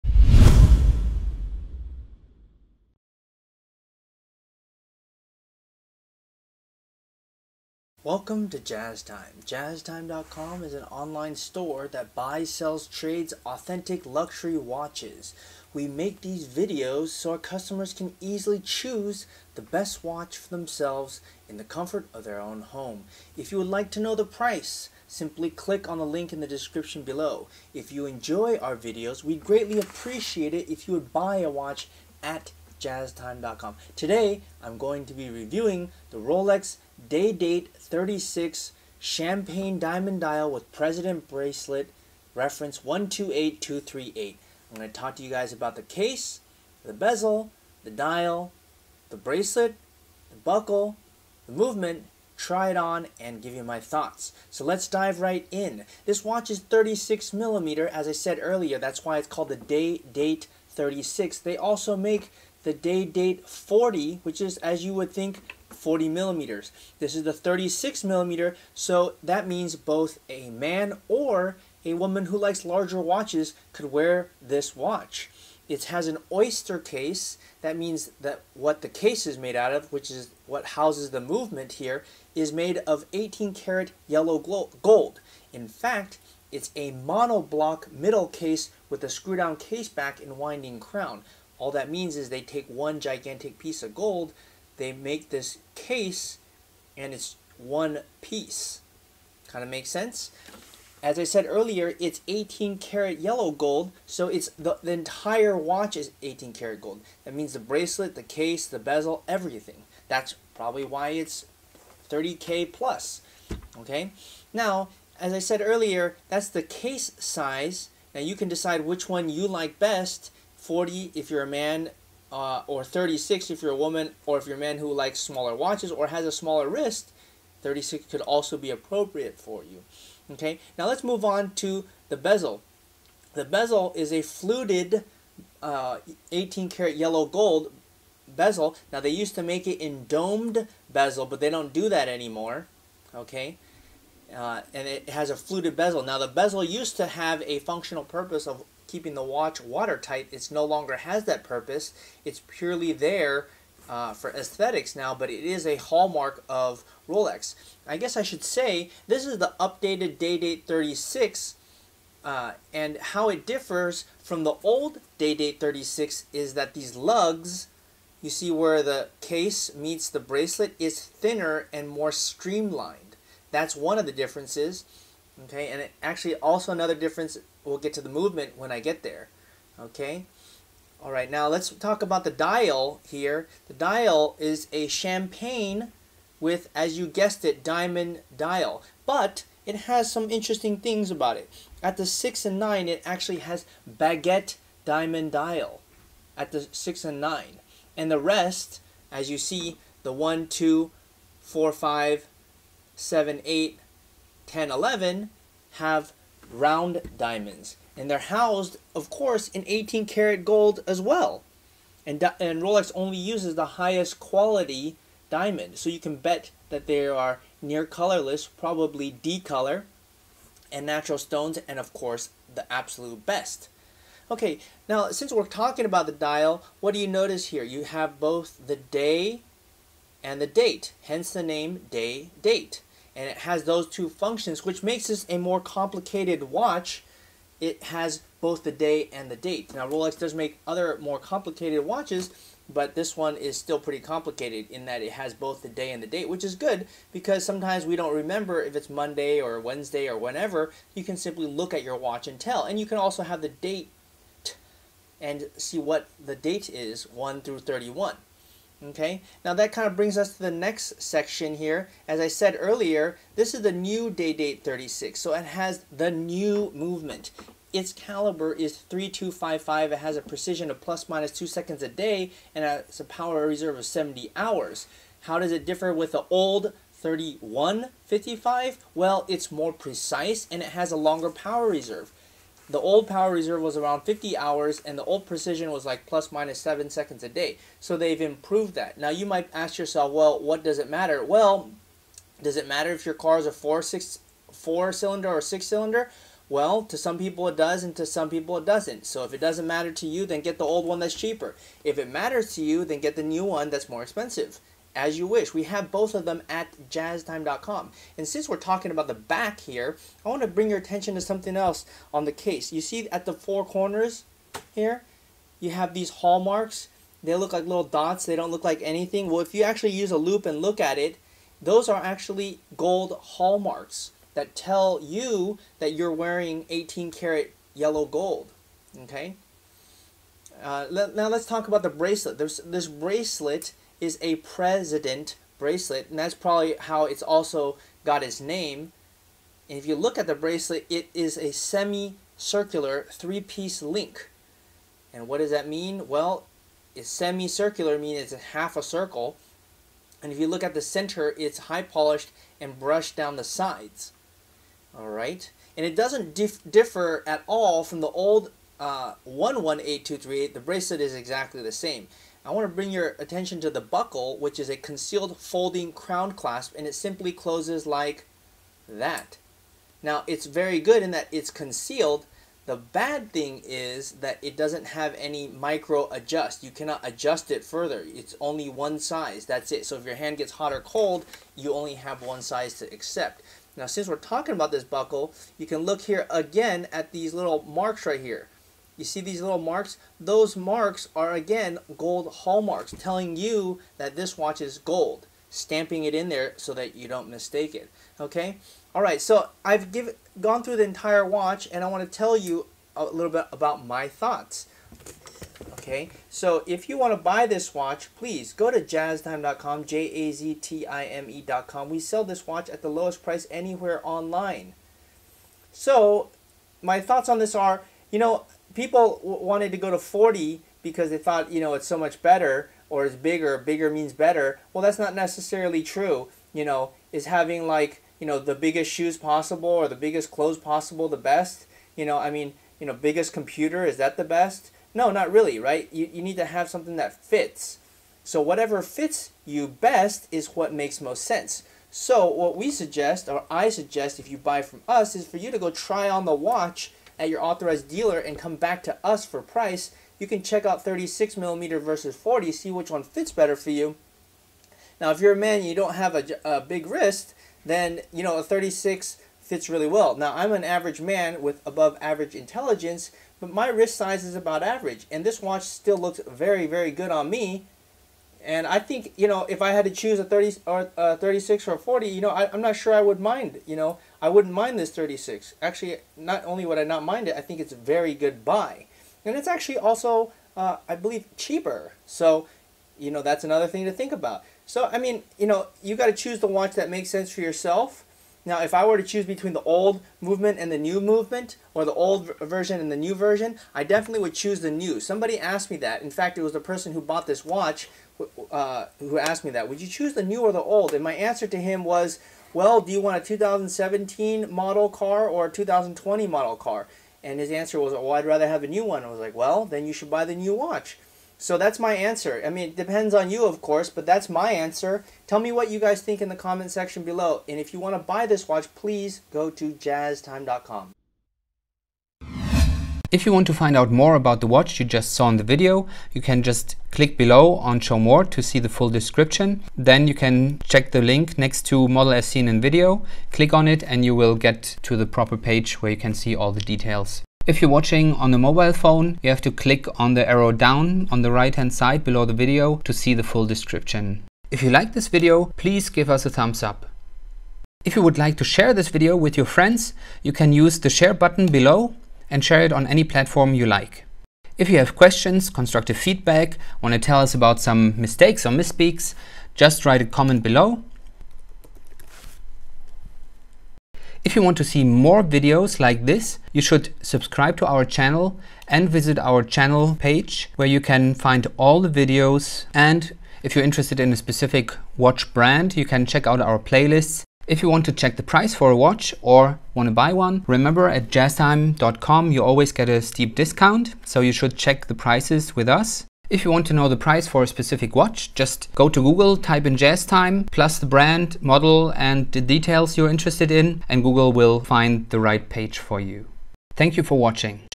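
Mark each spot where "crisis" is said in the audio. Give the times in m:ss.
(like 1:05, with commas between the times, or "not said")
not said.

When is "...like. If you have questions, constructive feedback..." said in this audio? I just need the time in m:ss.
9:13.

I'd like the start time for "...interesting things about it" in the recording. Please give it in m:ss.
3:10.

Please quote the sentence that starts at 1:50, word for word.
That's probably why it's 30k plus.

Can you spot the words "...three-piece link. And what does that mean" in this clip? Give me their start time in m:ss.
5:43.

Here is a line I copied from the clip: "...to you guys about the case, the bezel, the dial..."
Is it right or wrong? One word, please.
right.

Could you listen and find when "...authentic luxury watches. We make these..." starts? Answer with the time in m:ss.
0:13.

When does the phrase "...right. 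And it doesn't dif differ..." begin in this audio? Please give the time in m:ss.
5:55.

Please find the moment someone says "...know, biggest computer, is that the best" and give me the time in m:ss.
7:12.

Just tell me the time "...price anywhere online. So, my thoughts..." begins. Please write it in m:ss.
6:53.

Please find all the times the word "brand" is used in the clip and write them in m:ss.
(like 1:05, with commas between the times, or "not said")
9:35, 9:50.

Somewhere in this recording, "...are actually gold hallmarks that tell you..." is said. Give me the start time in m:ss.
5:21.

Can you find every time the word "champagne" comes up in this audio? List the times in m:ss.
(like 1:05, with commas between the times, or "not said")
0:38, 3:04.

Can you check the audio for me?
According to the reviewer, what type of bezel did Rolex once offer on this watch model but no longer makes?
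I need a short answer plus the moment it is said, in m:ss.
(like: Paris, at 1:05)
domed bezel, at 2:20.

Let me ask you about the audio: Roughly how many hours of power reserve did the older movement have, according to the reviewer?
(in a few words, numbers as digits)
50 hours.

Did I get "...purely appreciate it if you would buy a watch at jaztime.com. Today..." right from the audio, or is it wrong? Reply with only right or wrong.
wrong.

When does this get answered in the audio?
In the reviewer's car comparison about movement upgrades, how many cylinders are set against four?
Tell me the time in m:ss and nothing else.
4:55.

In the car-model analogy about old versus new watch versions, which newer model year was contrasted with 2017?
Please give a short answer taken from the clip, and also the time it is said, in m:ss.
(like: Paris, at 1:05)
2020, at 8:25.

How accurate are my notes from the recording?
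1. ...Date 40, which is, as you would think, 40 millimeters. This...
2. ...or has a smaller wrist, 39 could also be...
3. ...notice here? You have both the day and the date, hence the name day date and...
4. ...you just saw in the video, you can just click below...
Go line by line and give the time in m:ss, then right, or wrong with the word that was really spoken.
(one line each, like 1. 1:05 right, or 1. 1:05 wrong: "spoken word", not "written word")
1. 1:03 right
2. 2:05 wrong: "36", not "39"
3. 3:47 right
4. 8:44 right.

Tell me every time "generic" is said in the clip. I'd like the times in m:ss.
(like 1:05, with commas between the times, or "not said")
not said.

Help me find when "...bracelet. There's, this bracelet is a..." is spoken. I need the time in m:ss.
5:31.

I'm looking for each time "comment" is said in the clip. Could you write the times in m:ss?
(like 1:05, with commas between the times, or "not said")
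8:36, 9:20.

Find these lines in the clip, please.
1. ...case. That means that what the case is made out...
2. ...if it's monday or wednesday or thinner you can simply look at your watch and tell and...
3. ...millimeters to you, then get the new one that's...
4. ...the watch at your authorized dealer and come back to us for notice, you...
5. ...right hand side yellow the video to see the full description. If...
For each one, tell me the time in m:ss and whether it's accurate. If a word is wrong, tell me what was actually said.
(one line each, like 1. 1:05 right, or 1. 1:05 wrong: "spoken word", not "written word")
1. 1:16 right
2. 4:08 wrong: "whenever", not "thinner"
3. 5:02 wrong: "matters", not "millimeters"
4. 7:26 wrong: "price", not "notice"
5. 9:01 wrong: "below", not "yellow".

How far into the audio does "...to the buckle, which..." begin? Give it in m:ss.
6:03.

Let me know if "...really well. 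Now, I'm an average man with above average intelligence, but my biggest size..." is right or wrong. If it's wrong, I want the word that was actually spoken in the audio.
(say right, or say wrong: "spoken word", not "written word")
wrong: "wrist", not "biggest".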